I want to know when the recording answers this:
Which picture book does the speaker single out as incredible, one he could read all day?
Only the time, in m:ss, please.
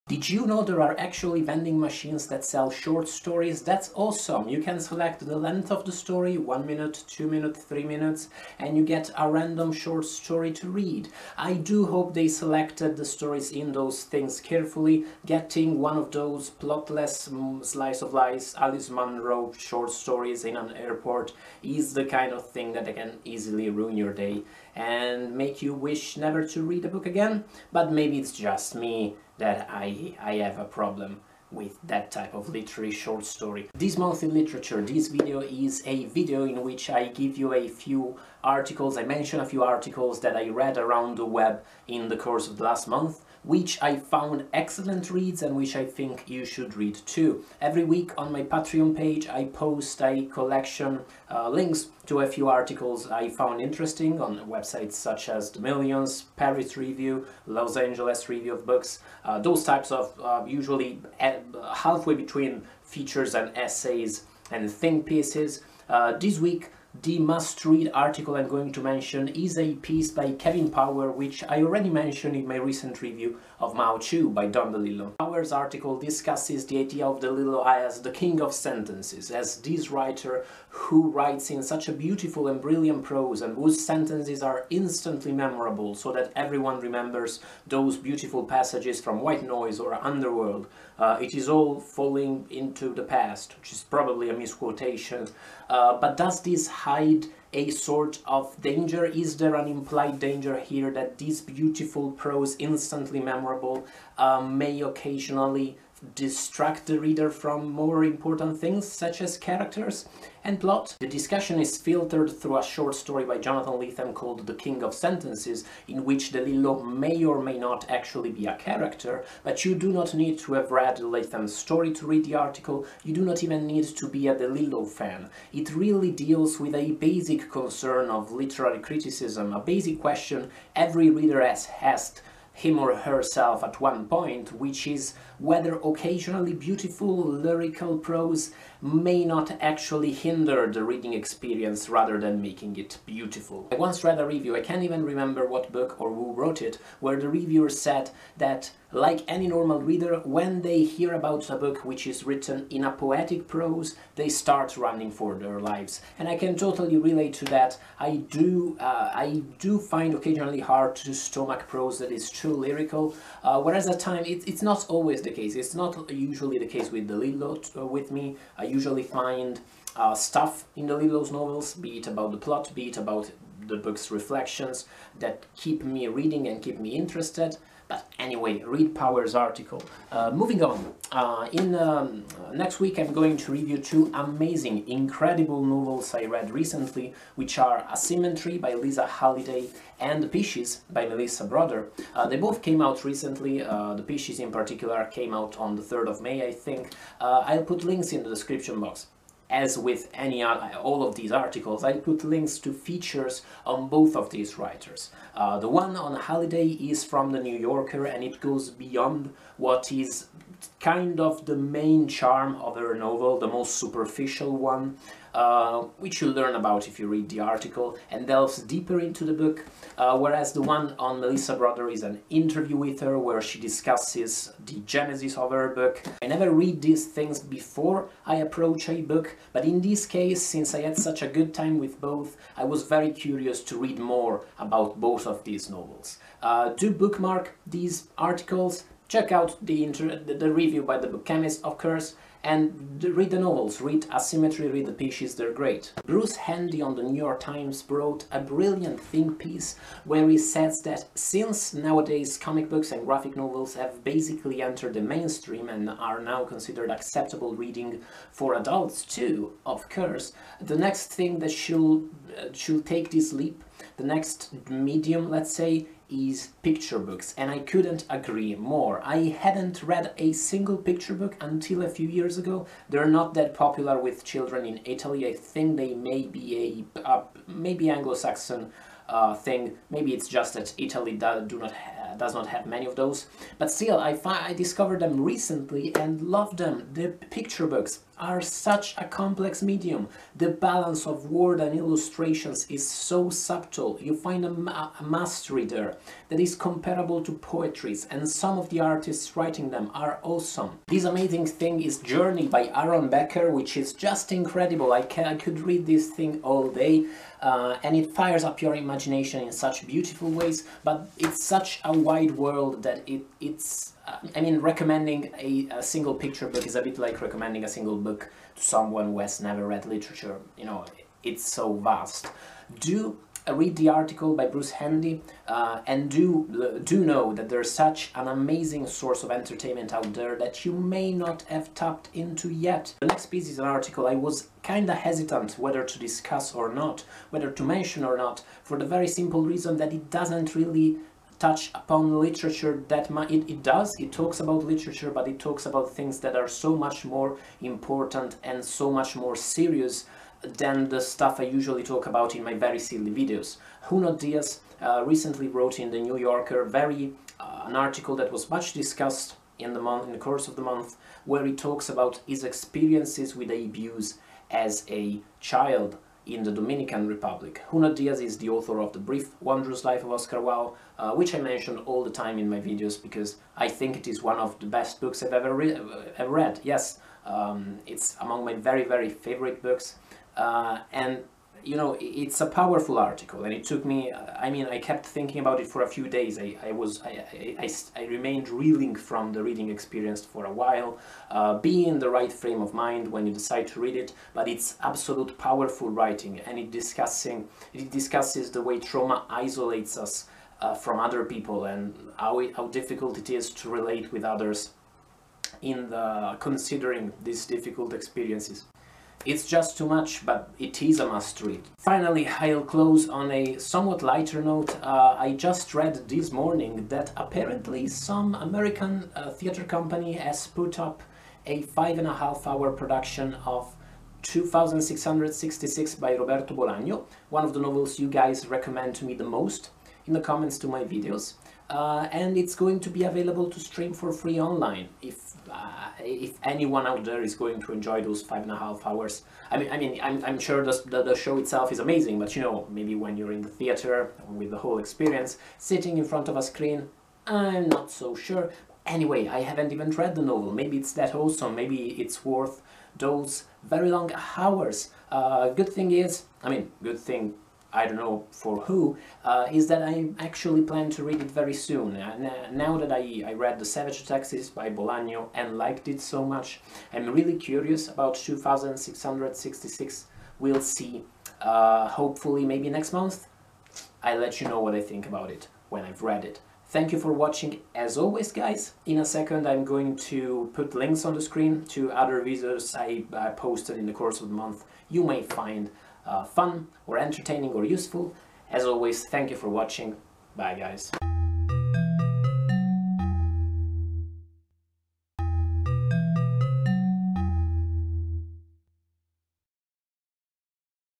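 5:01.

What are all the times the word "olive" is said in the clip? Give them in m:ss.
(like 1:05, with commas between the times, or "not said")
not said.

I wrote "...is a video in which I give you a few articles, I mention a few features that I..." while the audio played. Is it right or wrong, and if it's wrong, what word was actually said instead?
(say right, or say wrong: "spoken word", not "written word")
wrong: "articles", not "features".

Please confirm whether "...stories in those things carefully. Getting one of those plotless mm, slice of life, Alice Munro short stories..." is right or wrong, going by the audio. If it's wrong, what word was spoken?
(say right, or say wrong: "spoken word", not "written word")
right.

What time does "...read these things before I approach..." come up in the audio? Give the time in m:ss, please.
3:46.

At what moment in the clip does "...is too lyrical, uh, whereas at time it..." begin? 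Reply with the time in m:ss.
2:42.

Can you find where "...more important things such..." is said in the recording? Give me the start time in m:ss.
1:47.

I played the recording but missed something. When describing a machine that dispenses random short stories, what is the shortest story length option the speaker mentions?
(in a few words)
1 minute.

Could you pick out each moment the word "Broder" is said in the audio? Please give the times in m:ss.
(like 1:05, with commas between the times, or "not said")
3:11, 3:41.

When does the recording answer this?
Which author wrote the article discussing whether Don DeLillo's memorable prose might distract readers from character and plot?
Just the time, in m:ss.
1:10.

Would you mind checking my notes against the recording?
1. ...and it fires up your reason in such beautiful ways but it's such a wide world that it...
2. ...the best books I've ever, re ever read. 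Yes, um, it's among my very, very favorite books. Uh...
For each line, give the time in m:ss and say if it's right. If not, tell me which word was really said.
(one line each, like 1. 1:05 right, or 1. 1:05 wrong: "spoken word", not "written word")
1. 5:07 wrong: "imagination", not "reason"
2. 6:14 right.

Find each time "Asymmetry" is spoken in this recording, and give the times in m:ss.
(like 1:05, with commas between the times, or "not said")
3:07, 4:04.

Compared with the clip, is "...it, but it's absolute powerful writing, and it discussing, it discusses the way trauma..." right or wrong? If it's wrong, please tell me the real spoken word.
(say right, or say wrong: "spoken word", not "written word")
right.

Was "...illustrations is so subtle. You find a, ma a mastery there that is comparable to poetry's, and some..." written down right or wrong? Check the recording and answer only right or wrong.
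right.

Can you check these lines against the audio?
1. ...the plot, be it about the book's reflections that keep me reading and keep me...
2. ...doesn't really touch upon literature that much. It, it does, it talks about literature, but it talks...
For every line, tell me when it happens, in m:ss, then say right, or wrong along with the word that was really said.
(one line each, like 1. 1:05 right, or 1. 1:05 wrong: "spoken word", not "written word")
1. 2:52 right
2. 5:40 right.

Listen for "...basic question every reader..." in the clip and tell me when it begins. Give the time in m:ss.
2:09.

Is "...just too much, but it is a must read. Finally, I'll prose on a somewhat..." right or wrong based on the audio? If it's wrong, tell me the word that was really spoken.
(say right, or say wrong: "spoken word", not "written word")
wrong: "close", not "prose".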